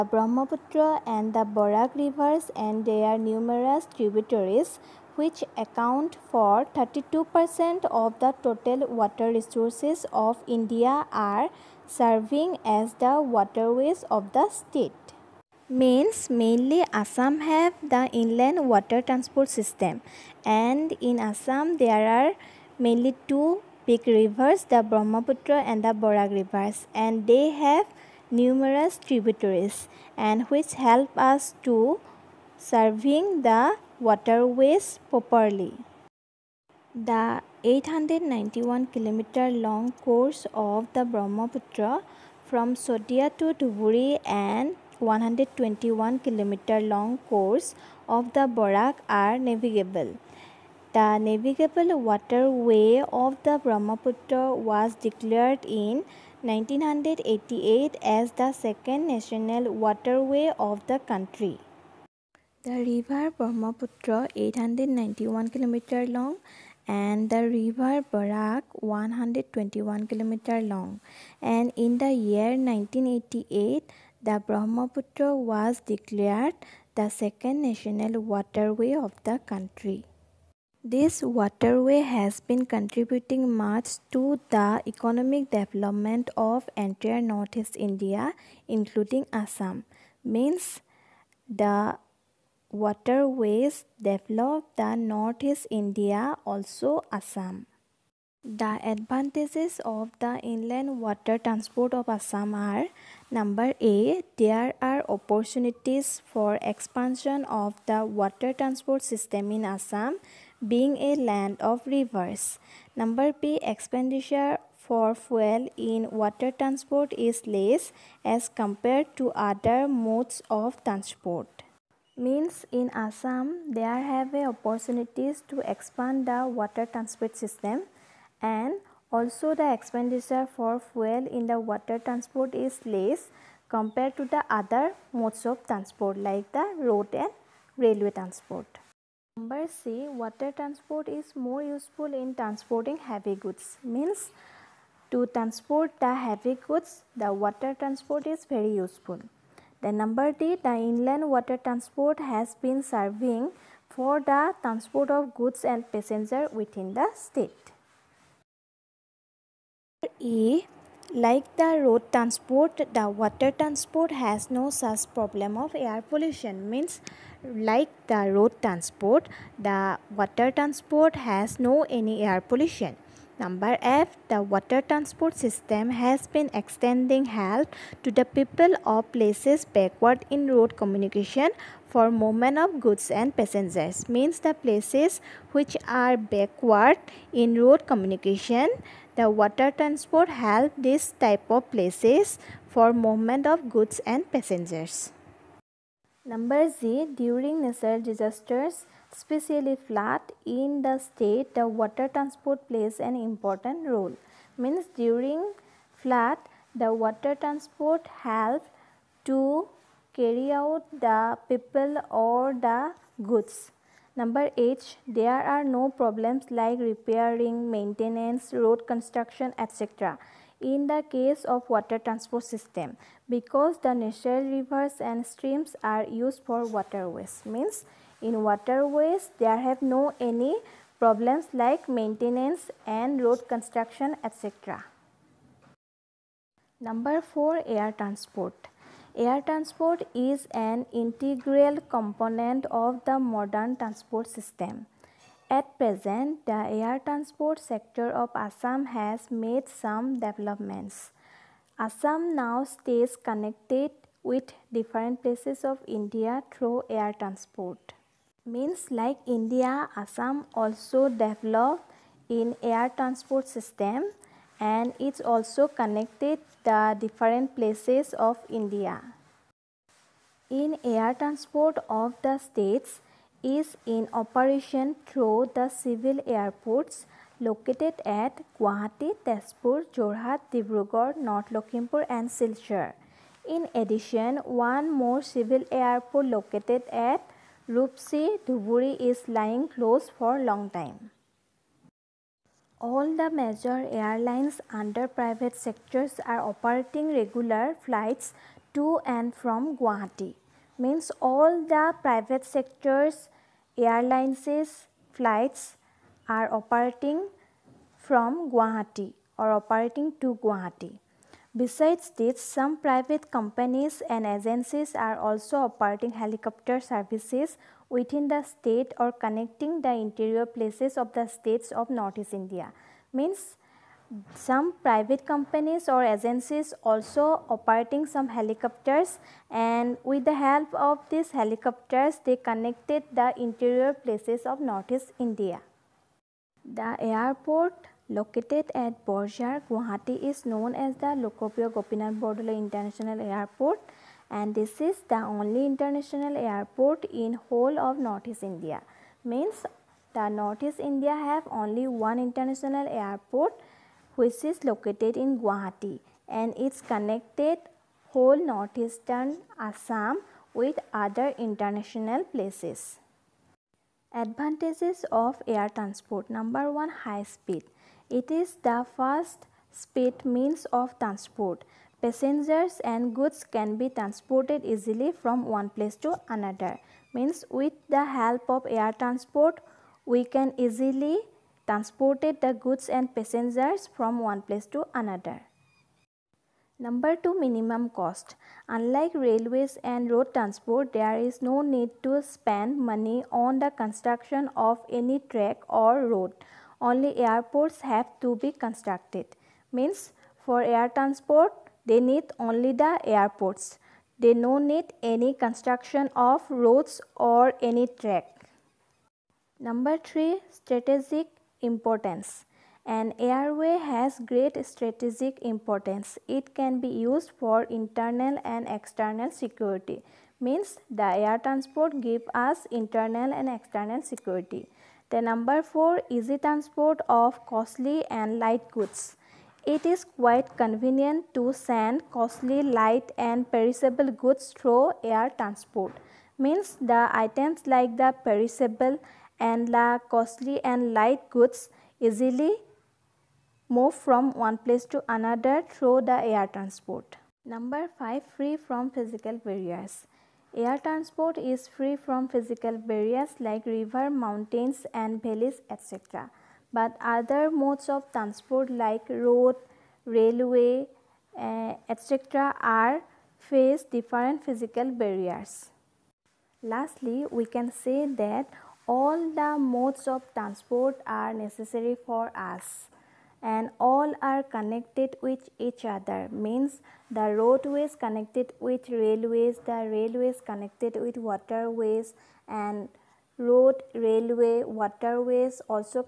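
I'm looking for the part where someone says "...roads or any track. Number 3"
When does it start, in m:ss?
6:46.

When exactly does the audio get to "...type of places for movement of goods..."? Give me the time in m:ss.
3:11.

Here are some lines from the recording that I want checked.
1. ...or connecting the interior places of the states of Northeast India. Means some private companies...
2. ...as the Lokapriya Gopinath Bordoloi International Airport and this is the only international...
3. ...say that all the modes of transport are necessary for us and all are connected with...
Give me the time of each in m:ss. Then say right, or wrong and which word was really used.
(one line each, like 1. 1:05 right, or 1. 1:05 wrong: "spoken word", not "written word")
1. 5:18 right
2. 5:40 right
3. 7:47 right.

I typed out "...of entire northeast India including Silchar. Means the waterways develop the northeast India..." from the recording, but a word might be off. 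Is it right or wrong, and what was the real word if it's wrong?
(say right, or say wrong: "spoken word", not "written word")
wrong: "Assam", not "Silchar".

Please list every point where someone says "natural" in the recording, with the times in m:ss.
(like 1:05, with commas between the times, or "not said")
3:17, 3:43.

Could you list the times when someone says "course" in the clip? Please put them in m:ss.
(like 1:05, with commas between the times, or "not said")
0:39, 0:47.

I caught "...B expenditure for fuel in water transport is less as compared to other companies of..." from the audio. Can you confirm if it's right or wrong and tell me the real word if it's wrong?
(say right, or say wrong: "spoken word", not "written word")
wrong: "modes", not "companies".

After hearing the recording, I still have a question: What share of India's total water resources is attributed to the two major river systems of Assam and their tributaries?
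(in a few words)
32%.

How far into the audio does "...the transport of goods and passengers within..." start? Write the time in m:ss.
2:34.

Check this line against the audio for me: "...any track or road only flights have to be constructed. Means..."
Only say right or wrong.
wrong.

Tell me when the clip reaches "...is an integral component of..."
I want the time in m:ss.
4:00.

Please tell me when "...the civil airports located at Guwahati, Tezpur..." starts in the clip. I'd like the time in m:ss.
4:35.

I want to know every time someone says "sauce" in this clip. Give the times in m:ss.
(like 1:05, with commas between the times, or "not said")
not said.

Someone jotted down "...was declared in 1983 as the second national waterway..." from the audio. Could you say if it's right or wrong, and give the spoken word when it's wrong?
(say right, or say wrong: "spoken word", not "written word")
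wrong: "1988", not "1983".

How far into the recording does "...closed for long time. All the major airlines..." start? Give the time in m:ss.
4:49.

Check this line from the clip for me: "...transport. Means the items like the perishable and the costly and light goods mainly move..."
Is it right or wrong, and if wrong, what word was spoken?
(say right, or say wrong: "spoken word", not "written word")
wrong: "easily", not "mainly".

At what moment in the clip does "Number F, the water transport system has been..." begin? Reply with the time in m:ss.
2:53.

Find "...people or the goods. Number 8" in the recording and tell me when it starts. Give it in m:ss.
3:31.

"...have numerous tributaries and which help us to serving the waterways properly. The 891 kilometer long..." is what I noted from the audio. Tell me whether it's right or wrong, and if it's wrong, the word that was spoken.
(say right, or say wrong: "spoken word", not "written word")
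right.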